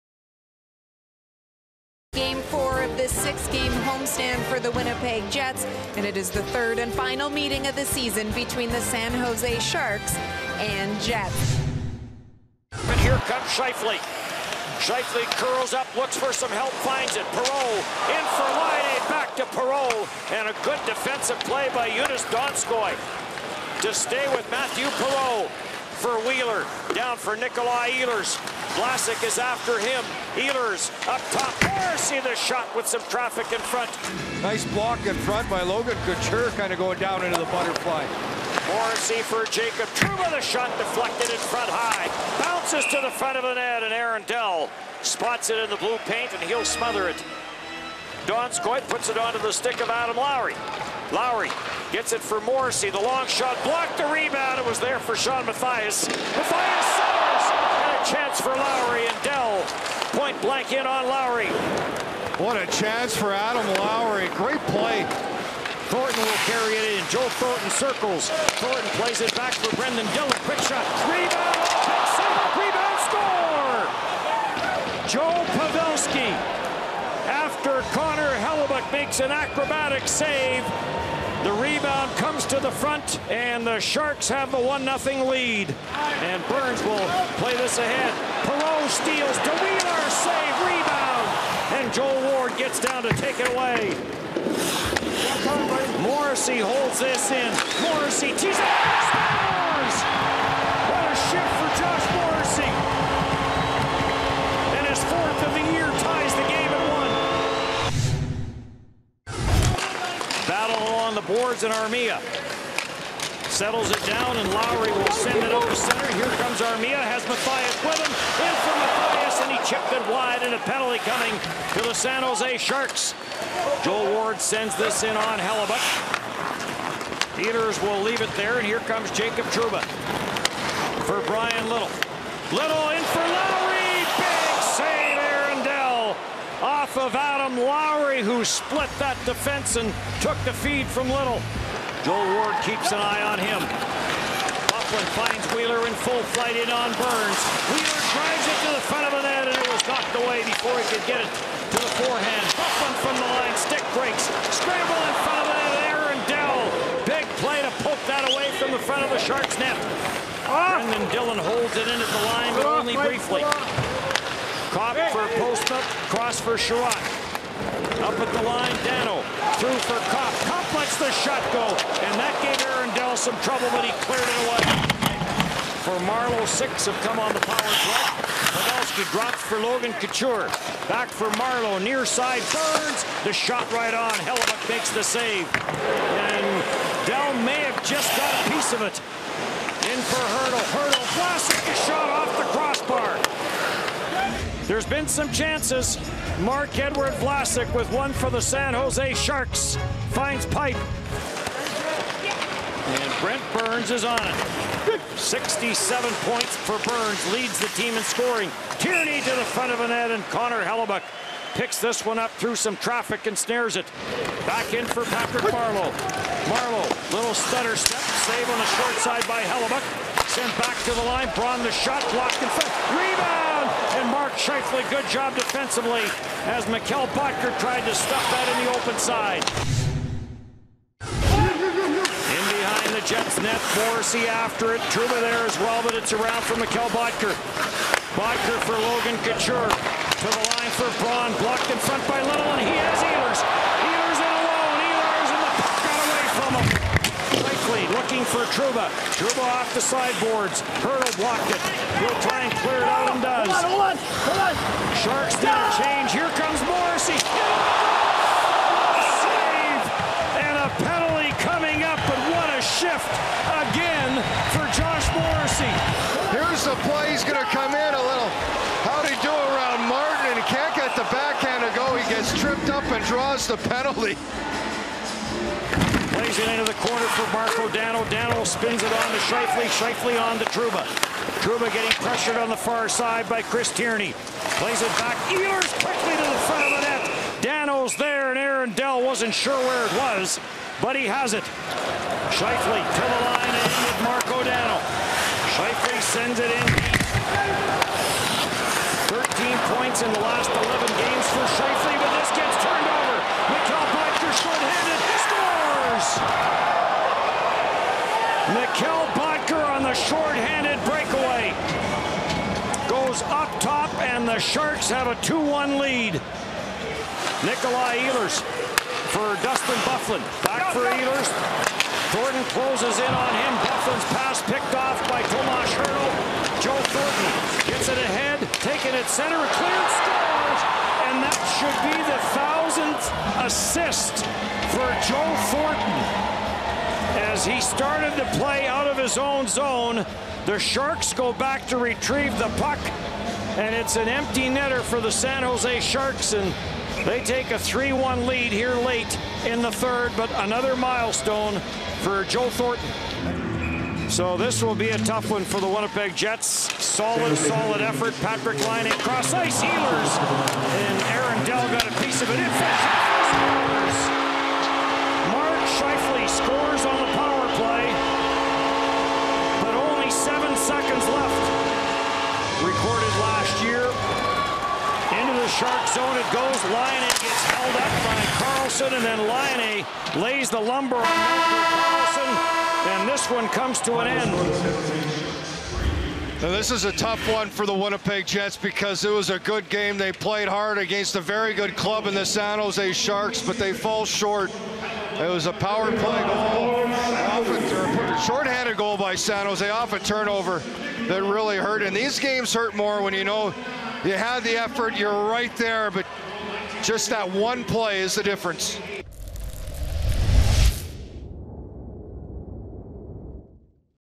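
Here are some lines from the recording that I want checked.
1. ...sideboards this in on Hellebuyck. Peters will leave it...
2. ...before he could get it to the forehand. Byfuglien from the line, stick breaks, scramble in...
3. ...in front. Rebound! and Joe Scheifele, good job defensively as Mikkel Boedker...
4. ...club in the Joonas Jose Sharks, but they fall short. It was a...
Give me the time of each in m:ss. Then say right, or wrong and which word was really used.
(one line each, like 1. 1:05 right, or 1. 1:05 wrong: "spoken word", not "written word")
1. 2:04 wrong: "sends", not "sideboards"
2. 2:30 right
3. 3:42 wrong: "Mark", not "Joe"
4. 6:31 wrong: "San", not "Joonas".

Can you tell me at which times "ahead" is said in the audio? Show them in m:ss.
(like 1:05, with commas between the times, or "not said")
1:27, 5:27.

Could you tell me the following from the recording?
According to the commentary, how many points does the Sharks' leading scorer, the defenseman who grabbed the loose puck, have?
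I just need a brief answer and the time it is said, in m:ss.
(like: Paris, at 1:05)
67, at 3:25.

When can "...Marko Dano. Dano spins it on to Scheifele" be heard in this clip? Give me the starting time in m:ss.
4:37.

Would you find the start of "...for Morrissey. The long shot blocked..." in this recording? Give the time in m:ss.
0:52.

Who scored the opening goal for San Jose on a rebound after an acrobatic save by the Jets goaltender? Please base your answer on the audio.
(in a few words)
Joe Pavelski.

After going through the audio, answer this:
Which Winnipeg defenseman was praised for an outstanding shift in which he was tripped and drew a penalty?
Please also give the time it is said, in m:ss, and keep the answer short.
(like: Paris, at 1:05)
Josh Morrissey, at 4:24.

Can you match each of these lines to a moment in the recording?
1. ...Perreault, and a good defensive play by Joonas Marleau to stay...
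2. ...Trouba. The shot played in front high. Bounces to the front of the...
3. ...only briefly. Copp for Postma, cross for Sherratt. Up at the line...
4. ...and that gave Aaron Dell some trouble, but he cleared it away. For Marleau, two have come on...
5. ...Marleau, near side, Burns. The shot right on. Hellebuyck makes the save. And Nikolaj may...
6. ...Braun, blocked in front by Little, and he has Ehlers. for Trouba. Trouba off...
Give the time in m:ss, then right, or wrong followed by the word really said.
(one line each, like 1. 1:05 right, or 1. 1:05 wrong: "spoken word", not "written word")
1. 0:19 wrong: "Donskoi", not "Marleau"
2. 0:39 wrong: "deflected", not "played"
3. 2:42 right
4. 2:52 wrong: "six", not "two"
5. 3:01 wrong: "Dell", not "Nikolaj"
6. 4:01 right.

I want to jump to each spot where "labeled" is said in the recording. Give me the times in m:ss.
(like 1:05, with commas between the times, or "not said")
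not said.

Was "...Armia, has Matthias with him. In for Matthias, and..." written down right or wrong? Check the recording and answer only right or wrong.
right.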